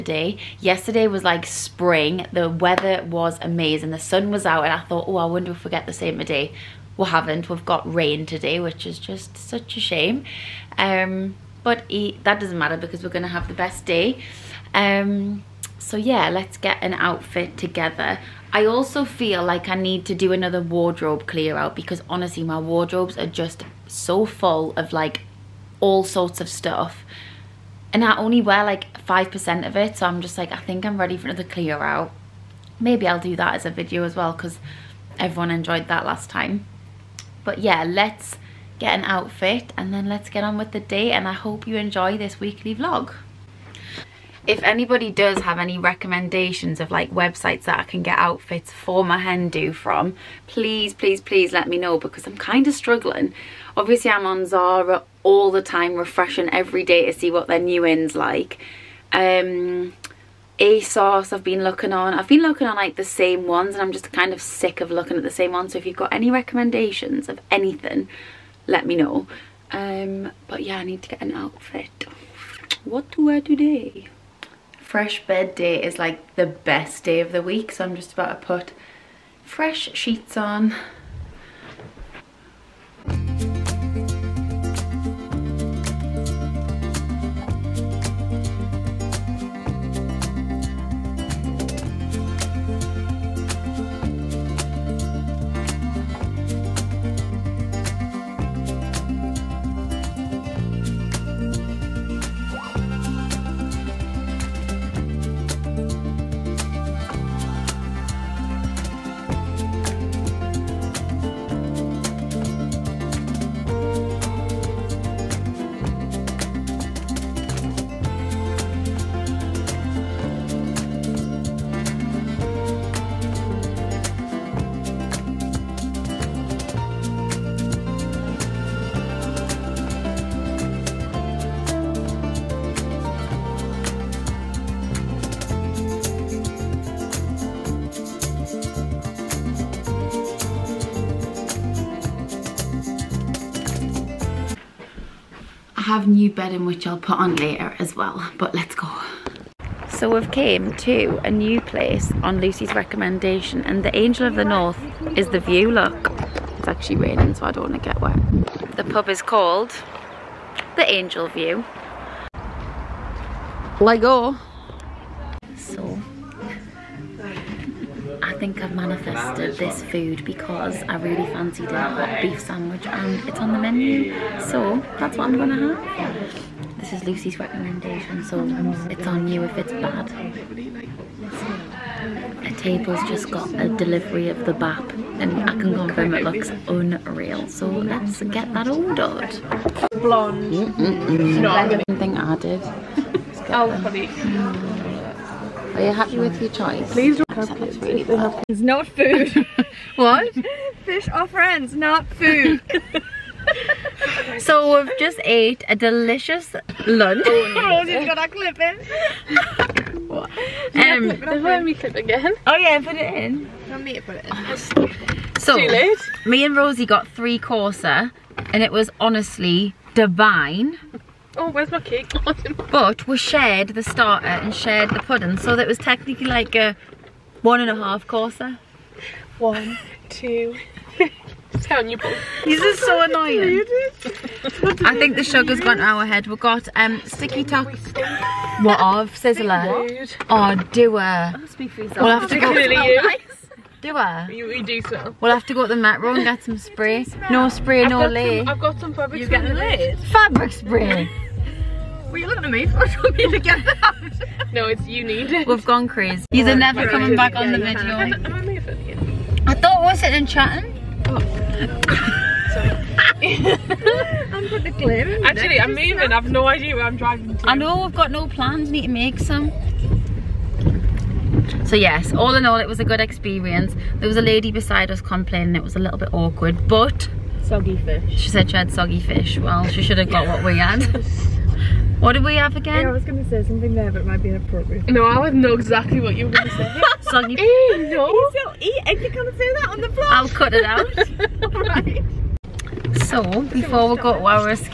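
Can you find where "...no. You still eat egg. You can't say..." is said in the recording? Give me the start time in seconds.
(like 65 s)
287 s.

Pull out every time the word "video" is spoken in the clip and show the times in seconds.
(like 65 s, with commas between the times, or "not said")
33 s, 257 s.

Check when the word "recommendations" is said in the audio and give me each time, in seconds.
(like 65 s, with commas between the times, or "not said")
45 s, 66 s, 152 s, 177 s.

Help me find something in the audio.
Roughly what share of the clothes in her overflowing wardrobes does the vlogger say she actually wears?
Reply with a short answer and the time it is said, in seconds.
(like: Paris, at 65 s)
5%, at 29 s.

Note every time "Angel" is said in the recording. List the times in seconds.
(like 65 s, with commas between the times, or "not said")
153 s, 160 s.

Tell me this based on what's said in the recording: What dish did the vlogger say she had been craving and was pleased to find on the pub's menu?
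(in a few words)
hot beef sandwich.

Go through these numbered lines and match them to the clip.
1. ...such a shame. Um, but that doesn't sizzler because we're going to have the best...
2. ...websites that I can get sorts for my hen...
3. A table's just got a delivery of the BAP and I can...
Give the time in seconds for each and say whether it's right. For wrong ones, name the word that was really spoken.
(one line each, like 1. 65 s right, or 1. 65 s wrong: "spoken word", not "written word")
1. 9 s wrong: "matter", not "sizzler"
2. 47 s wrong: "outfits", not "sorts"
3. 182 s right.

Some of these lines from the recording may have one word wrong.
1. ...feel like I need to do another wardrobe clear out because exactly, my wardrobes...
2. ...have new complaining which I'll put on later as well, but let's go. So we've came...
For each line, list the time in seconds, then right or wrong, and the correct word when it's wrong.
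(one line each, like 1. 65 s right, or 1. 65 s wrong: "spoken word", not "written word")
1. 19 s wrong: "honestly", not "exactly"
2. 145 s wrong: "bedding", not "complaining".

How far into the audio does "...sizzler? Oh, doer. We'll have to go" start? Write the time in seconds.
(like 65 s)
239 s.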